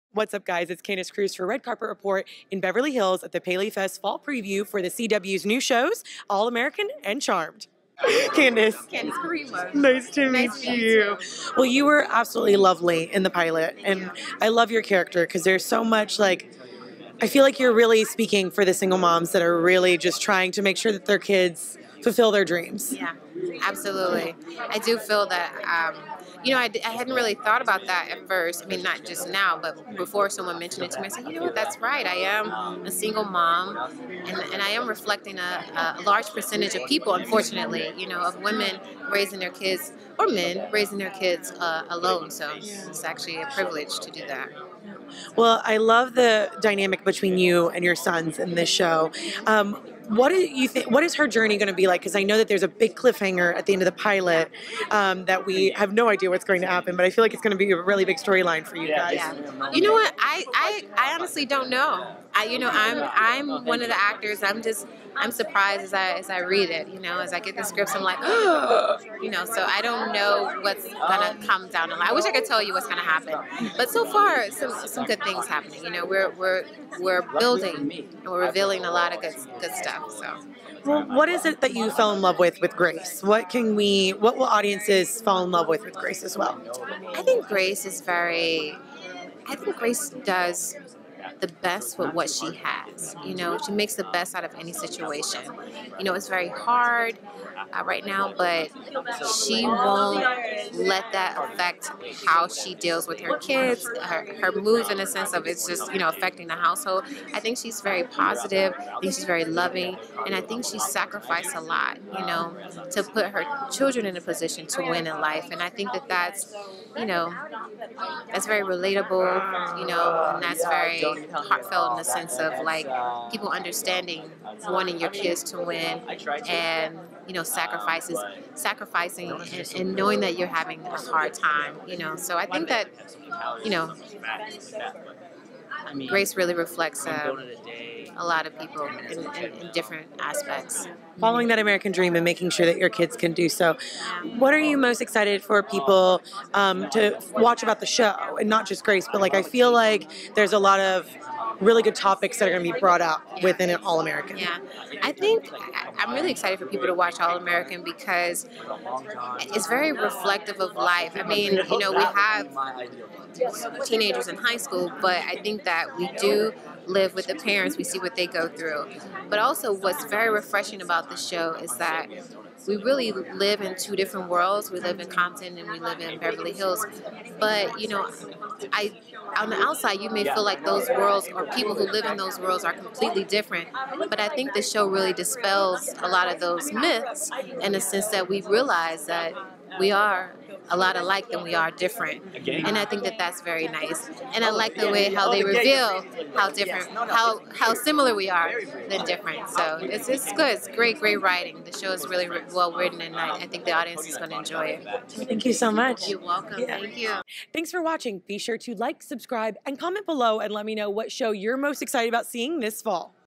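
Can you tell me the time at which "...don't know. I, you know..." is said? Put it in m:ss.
1:01.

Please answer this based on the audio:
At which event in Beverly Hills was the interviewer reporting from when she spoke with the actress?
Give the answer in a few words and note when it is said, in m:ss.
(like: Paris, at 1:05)
Paley Fest Fall Preview, at 0:03.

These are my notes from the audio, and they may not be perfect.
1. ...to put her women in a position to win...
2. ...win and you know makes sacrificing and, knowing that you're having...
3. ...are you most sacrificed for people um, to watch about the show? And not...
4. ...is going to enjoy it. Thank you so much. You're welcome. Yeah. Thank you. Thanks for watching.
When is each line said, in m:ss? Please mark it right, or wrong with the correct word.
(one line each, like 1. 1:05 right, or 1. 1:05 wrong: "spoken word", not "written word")
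1. 1:52 wrong: "children", not "women"
2. 2:05 wrong: "sacrifices", not "makes"
3. 2:24 wrong: "excited", not "sacrificed"
4. 3:24 right.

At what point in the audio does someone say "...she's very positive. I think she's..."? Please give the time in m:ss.
1:47.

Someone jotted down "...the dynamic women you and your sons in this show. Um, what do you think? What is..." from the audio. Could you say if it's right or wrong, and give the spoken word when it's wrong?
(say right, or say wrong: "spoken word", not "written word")
wrong: "between", not "women".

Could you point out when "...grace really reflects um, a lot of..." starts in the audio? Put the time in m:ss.
2:16.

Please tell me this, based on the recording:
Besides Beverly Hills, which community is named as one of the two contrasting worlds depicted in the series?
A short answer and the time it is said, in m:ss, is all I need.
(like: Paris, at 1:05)
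Compton, at 2:55.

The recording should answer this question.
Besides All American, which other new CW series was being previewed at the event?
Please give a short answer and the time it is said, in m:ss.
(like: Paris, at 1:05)
Charmed, at 0:07.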